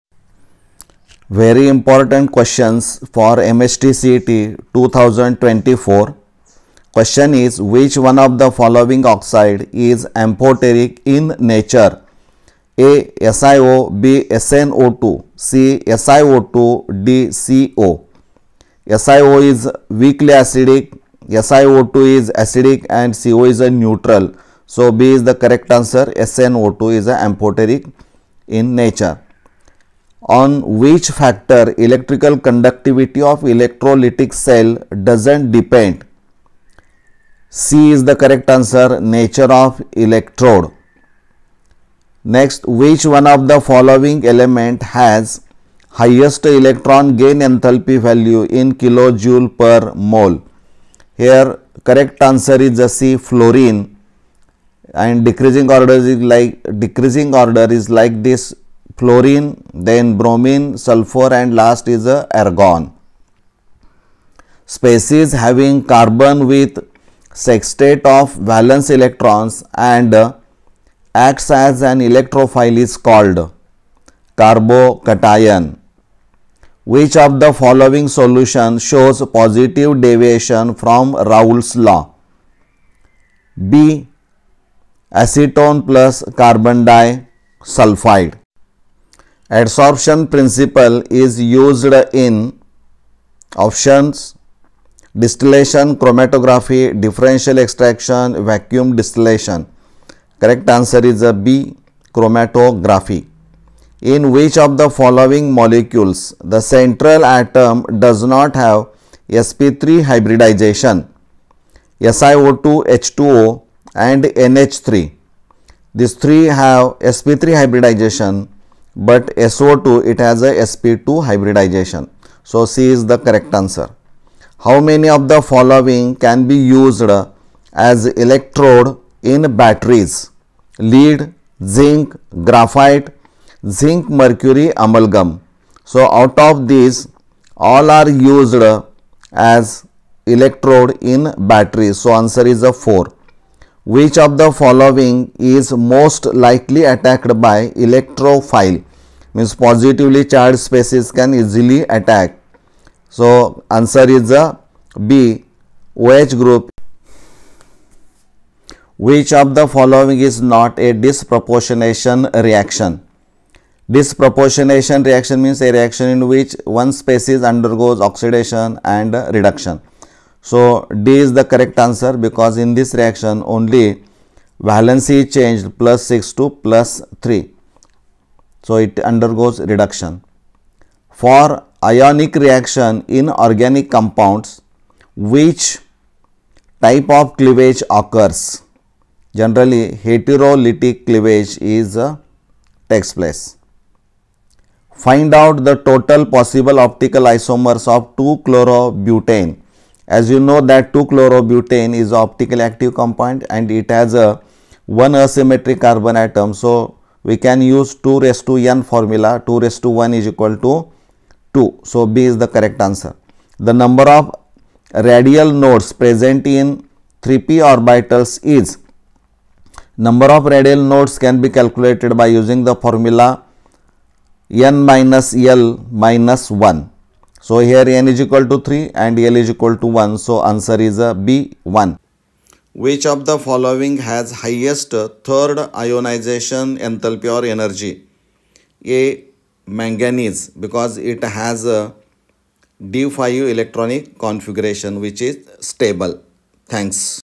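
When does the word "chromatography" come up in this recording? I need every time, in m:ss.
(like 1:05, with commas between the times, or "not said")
1:35, 1:42.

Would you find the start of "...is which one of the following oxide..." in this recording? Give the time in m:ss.
0:07.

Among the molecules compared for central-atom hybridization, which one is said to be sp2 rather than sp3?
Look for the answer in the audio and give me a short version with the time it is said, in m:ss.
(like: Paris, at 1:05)
SO2, at 1:59.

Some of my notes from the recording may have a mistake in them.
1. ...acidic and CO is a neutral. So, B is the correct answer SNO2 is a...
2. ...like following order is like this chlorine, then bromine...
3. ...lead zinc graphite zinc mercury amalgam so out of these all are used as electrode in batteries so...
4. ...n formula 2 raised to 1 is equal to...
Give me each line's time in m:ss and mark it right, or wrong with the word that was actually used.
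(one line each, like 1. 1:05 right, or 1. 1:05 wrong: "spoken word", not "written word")
1. 0:22 right
2. 0:56 wrong: "decreasing", not "following"
3. 2:10 right
4. 3:28 right.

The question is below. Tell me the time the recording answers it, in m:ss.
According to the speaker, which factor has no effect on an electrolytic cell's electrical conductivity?
0:39.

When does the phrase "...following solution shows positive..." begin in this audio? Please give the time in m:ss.
1:17.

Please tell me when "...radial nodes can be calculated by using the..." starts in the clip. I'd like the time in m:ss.
3:40.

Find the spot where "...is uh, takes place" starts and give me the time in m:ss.
3:11.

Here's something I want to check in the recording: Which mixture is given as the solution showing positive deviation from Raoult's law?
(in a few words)
Acetone plus carbon disulfide.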